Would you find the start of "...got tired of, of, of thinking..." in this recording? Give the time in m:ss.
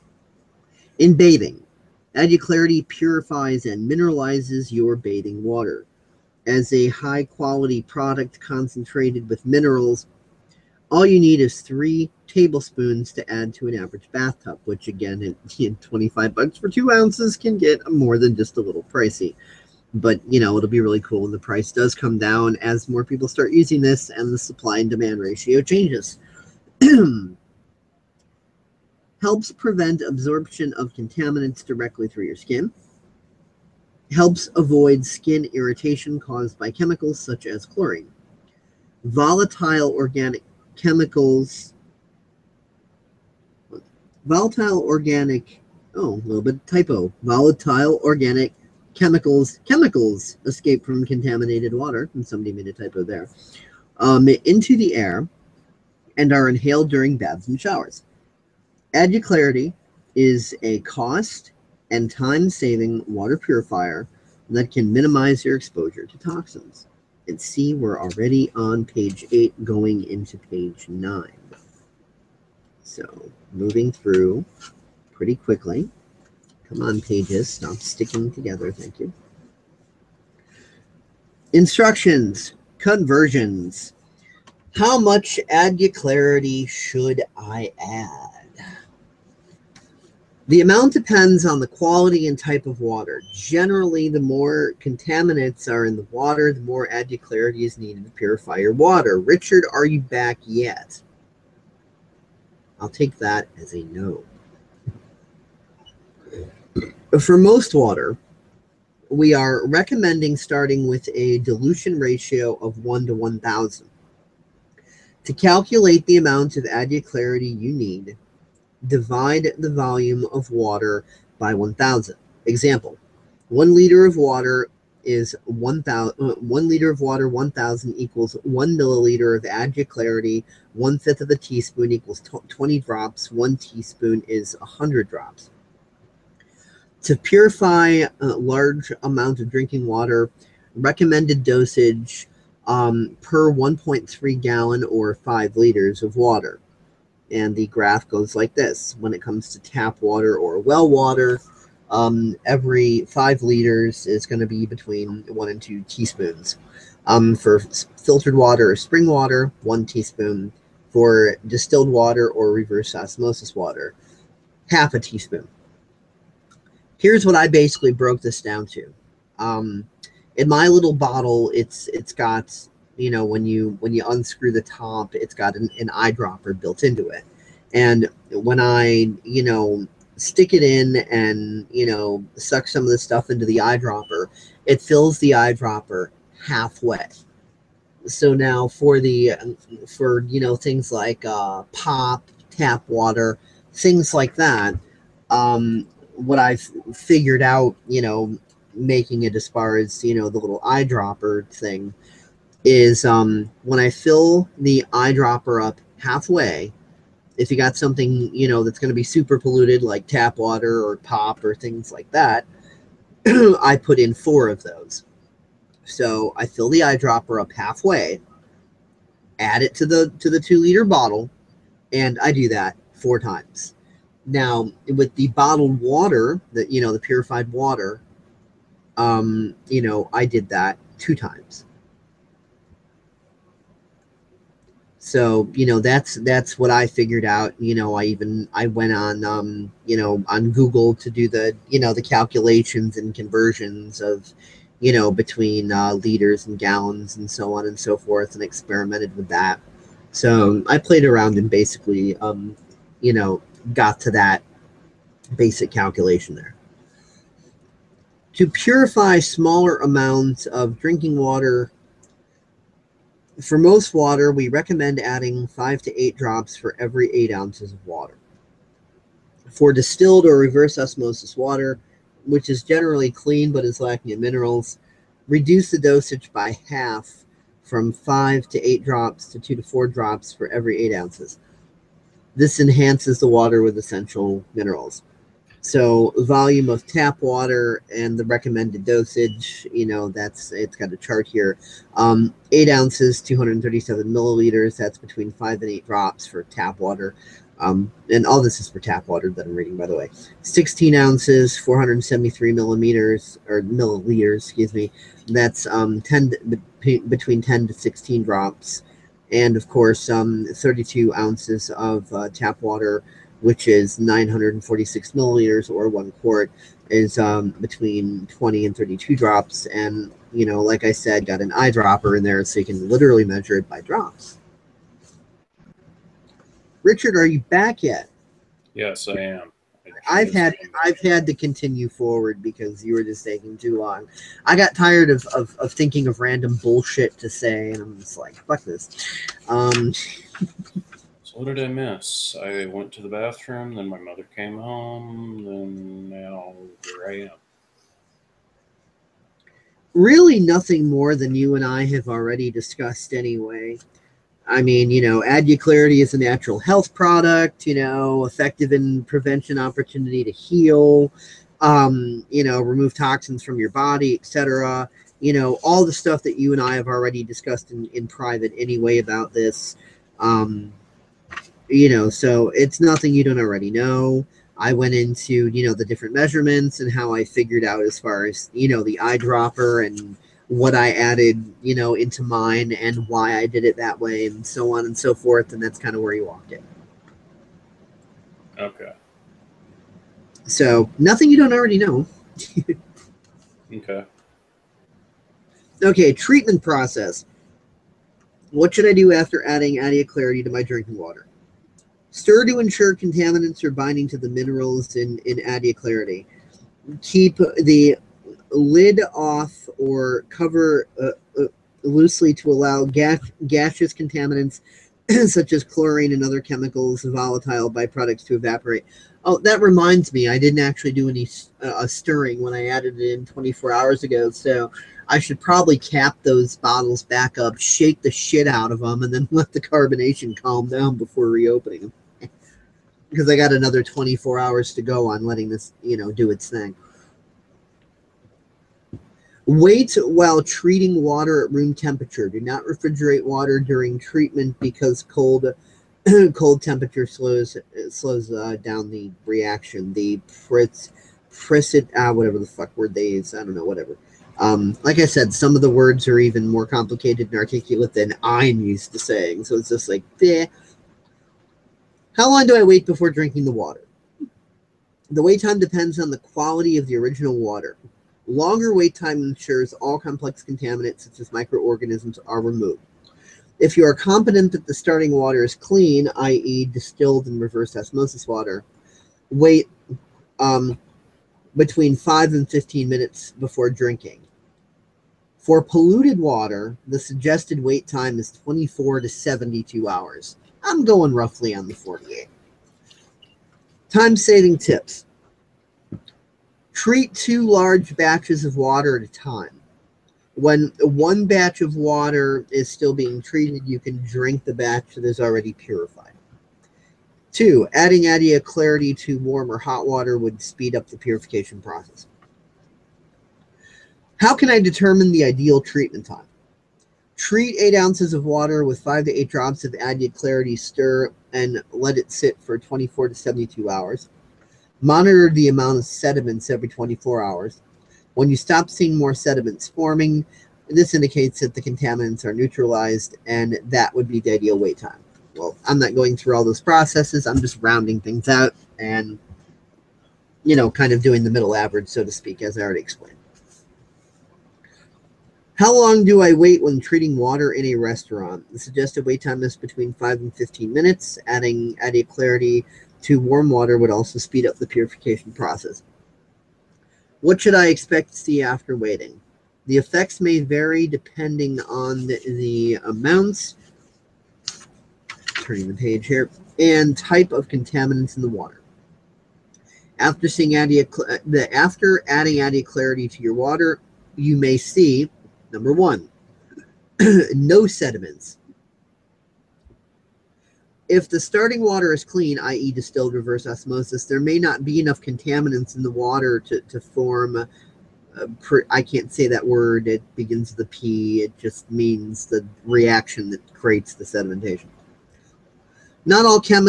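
5:34.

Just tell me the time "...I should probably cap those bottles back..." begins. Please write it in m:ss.
7:05.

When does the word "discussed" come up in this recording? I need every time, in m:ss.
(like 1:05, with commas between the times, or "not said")
5:52, 6:07.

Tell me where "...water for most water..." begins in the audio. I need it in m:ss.
4:21.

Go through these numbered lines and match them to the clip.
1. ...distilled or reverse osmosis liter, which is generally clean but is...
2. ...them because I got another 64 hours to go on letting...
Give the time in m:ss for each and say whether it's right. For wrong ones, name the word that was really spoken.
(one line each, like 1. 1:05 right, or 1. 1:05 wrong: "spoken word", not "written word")
1. 4:29 wrong: "water", not "liter"
2. 7:11 wrong: "24", not "64".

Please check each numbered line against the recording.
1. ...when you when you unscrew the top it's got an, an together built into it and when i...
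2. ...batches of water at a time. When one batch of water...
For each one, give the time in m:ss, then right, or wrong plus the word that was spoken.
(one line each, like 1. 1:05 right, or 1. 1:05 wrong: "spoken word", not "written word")
1. 2:53 wrong: "eyedropper", not "together"
2. 8:17 right.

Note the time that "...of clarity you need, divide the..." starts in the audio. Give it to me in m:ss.
1:56.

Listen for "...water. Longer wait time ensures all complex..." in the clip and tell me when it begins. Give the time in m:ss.
7:47.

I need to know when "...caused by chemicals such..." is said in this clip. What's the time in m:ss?
0:36.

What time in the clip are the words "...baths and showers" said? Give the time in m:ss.
0:57.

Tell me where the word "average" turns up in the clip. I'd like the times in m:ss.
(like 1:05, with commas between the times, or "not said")
0:13, 9:01.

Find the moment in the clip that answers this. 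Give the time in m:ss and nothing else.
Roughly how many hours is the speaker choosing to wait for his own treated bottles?
8:11.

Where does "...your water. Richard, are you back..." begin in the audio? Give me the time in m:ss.
1:38.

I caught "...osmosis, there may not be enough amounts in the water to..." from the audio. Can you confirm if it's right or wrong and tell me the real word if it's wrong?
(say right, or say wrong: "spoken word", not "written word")
wrong: "contaminants", not "amounts".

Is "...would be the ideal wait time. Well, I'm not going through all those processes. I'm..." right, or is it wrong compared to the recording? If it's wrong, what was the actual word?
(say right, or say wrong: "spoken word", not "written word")
right.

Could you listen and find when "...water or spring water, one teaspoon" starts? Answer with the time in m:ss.
2:38.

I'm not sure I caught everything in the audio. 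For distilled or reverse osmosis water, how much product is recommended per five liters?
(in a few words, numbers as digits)
half a teaspoon.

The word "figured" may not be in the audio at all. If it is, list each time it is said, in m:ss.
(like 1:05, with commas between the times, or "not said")
3:16, 3:56, 6:17.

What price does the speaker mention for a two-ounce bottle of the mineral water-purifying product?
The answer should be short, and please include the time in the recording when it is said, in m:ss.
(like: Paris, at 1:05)
$25, at 0:15.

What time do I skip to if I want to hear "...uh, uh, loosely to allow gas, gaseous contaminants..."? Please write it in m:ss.
6:51.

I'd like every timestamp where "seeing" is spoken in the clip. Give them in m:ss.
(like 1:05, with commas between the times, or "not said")
8:48, 9:30.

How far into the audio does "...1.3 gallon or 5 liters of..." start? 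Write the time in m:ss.
2:23.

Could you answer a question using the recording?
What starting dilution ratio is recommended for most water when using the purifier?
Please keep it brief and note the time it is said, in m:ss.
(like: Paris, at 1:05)
1 to 1,000, at 1:52.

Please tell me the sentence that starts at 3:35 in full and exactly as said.
So I fill the eyedropper up halfway, add it to the to the two liter bottle, and I do that four times.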